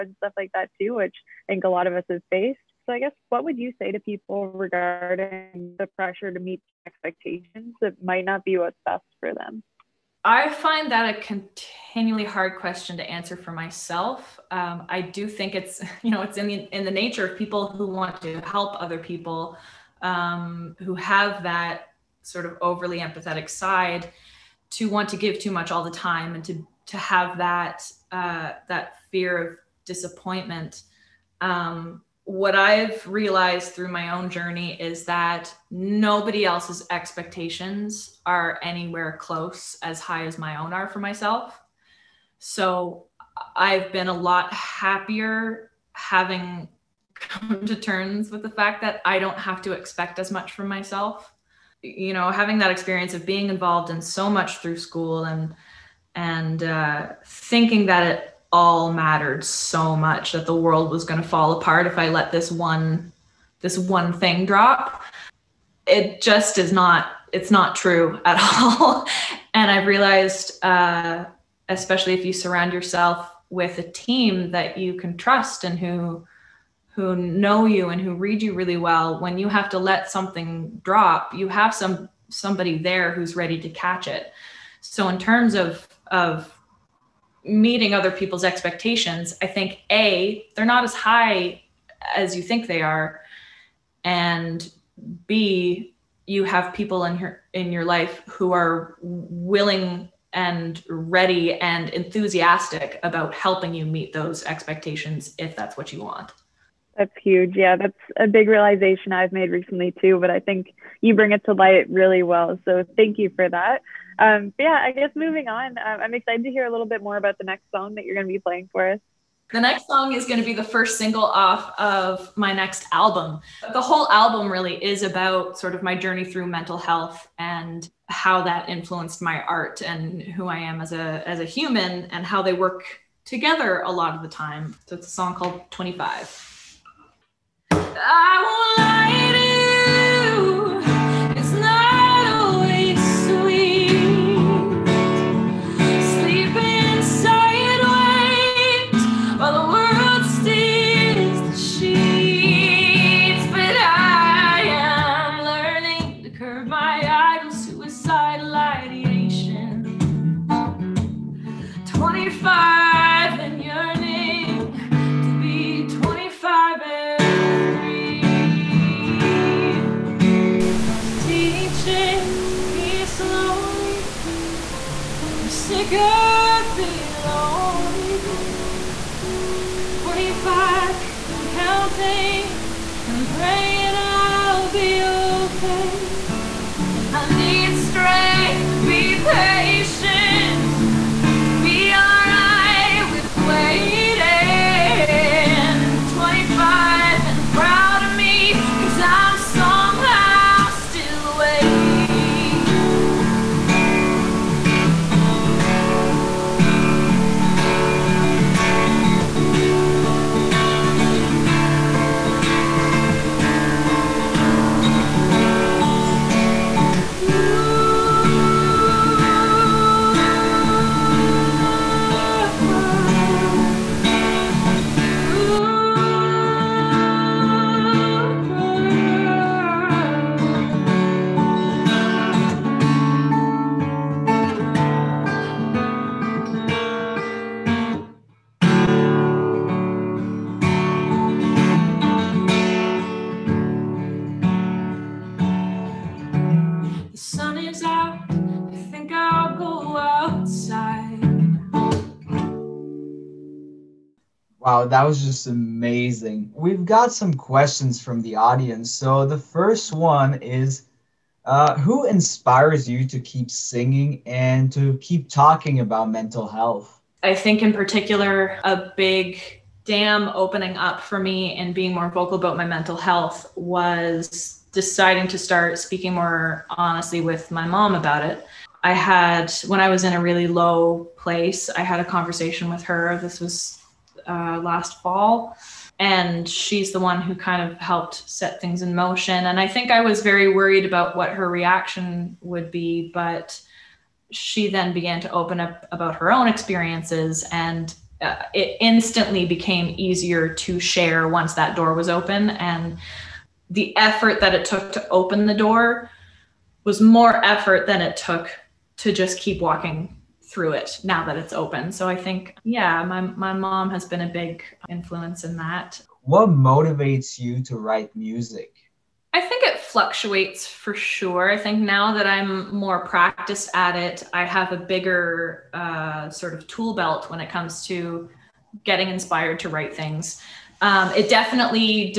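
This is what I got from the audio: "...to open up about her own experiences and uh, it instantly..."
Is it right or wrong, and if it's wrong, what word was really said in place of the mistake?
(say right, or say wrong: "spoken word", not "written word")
right.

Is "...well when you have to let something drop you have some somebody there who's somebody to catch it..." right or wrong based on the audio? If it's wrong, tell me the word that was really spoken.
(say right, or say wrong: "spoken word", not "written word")
wrong: "ready", not "somebody".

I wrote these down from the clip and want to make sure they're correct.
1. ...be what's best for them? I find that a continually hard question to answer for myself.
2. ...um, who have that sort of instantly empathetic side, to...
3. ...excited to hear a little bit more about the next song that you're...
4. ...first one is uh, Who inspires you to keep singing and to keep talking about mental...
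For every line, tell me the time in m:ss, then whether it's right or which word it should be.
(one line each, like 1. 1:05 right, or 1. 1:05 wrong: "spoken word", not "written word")
1. 0:08 right
2. 0:20 wrong: "overly", not "instantly"
3. 1:56 right
4. 4:19 right.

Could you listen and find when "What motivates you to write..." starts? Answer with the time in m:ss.
5:16.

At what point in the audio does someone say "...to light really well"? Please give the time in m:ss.
1:51.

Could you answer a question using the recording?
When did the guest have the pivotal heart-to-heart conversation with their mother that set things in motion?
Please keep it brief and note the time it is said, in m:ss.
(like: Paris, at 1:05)
last fall, at 4:44.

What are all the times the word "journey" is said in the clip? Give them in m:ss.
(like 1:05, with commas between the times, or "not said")
0:34, 2:05.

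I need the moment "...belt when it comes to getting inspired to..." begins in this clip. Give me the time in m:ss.
5:26.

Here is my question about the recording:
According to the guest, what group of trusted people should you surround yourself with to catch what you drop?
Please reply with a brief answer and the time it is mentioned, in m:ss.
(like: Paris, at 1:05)
a team, at 1:13.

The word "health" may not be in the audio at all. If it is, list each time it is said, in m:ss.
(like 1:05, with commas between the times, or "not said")
2:06, 4:26, 4:32.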